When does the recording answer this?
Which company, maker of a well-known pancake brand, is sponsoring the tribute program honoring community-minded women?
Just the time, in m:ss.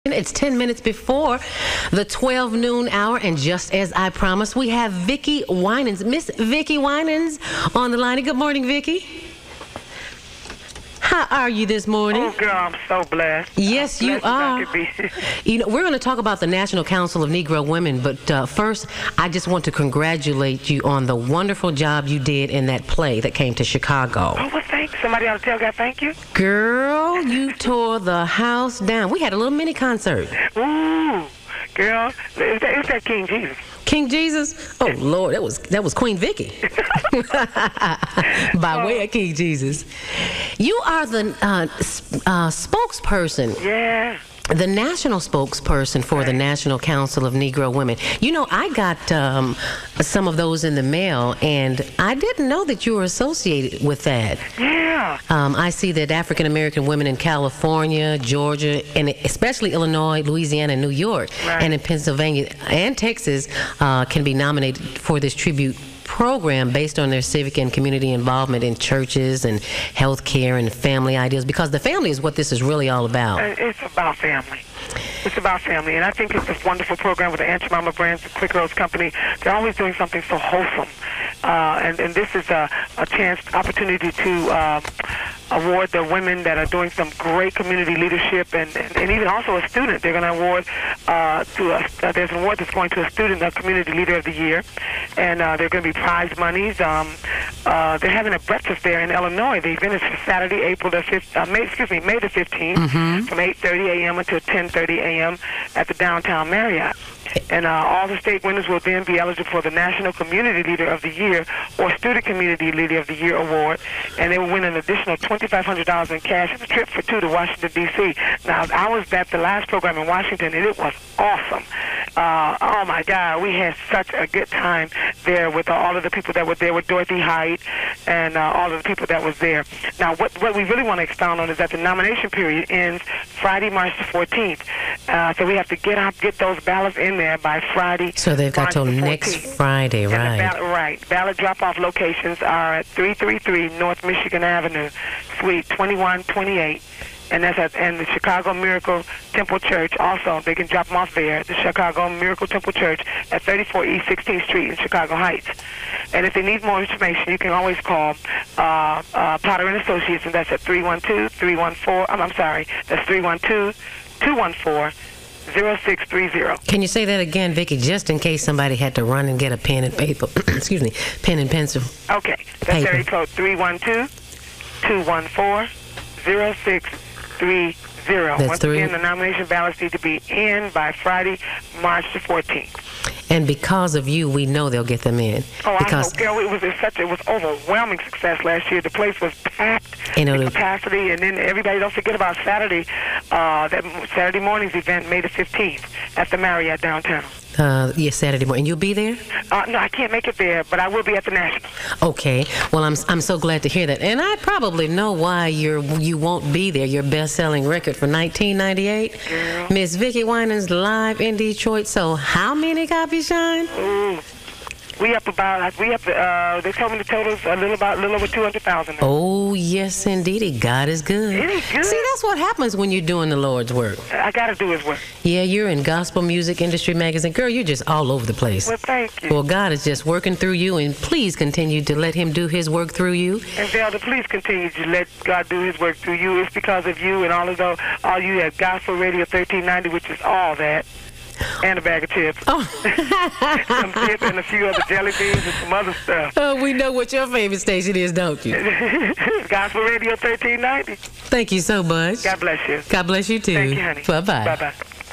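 1:18.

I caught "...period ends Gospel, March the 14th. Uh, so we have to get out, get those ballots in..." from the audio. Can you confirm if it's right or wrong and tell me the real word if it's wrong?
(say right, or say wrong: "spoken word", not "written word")
wrong: "Friday", not "Gospel".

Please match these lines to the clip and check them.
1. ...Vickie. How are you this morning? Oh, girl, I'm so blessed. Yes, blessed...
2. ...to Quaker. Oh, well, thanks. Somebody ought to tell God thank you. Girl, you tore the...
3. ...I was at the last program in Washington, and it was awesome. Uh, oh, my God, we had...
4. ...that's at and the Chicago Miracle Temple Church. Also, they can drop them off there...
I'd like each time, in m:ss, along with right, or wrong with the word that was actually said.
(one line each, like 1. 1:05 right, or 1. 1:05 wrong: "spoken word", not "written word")
1. 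0:08 right
2. 0:23 wrong: "Chicago", not "Quaker"
3. 1:58 right
4. 2:27 right.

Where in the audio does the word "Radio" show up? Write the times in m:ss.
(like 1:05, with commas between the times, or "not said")
3:58, 4:09.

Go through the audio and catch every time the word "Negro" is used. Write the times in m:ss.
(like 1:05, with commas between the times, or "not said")
0:17, 0:47.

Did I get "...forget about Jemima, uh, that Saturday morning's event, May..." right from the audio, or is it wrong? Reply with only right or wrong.
wrong.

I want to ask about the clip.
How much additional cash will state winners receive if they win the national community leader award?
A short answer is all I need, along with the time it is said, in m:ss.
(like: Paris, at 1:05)
$2,500, at 1:55.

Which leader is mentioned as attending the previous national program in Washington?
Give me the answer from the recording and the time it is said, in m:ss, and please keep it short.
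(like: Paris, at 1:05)
Dorothy Height, at 2:06.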